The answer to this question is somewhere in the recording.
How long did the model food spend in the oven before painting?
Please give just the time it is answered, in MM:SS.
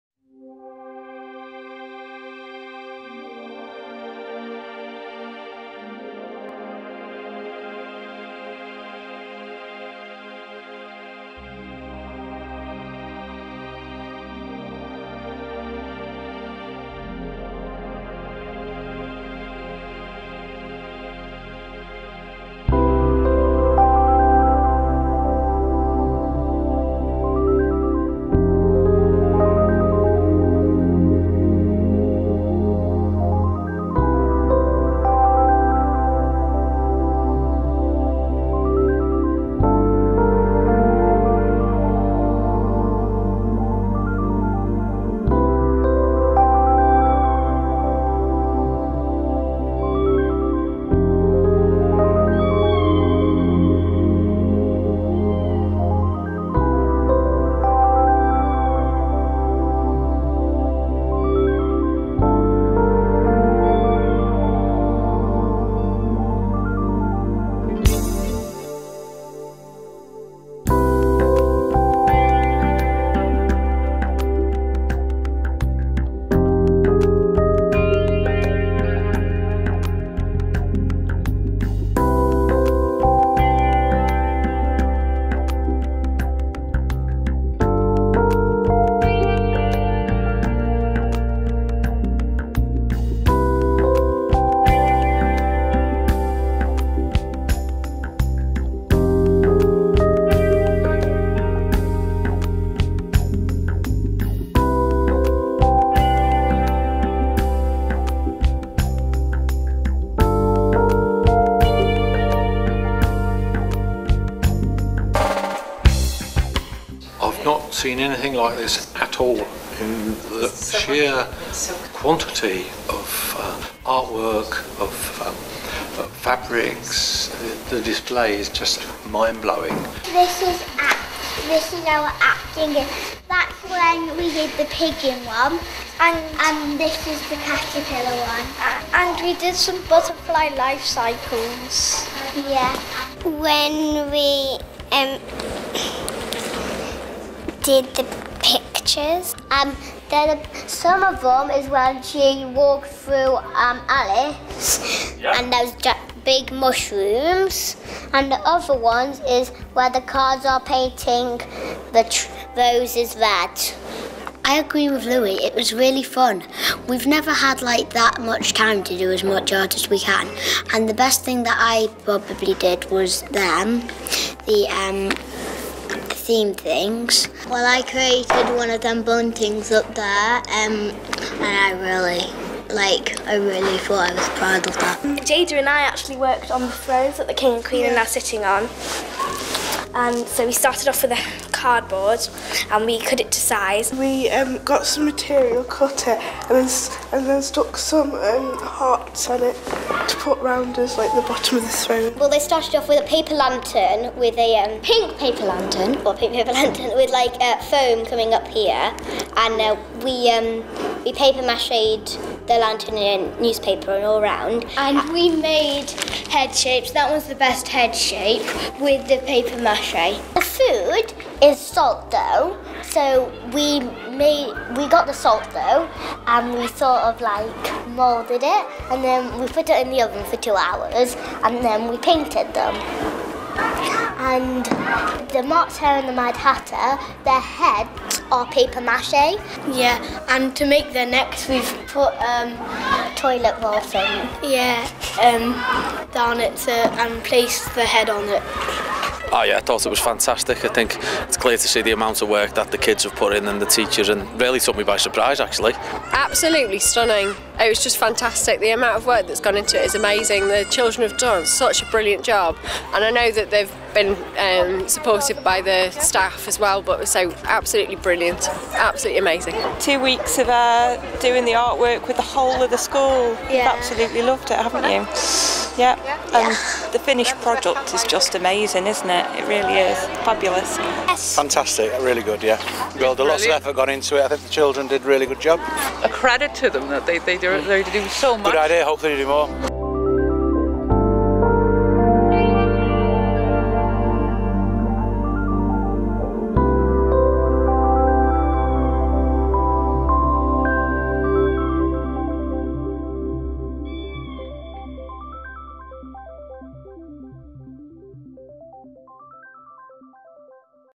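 03:50.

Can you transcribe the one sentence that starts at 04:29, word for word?
Two weeks of uh, doing the artwork with the whole of the school.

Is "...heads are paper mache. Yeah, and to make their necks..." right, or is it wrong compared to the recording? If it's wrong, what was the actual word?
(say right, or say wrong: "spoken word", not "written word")
right.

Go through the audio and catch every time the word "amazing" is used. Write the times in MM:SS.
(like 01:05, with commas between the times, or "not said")
04:19, 04:29, 04:38.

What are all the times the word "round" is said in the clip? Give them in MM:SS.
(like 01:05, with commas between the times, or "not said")
03:20, 03:34.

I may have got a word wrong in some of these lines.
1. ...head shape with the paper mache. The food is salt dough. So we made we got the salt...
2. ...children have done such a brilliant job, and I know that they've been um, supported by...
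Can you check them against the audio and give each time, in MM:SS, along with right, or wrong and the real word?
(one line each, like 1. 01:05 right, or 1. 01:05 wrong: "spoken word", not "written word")
1. 03:37 right
2. 04:20 right.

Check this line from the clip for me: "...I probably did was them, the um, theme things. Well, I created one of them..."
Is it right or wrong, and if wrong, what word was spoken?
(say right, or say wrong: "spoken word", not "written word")
right.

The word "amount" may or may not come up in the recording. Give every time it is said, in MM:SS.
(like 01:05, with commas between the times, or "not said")
04:11, 04:18.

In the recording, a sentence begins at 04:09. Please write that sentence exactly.
Oh yeah, I thought it was fantastic.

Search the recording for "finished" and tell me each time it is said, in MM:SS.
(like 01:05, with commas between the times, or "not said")
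04:36.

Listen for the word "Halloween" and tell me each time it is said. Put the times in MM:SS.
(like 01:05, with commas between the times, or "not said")
not said.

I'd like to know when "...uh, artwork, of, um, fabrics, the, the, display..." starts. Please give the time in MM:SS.
02:03.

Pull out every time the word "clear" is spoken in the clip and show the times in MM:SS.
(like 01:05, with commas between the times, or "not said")
04:11.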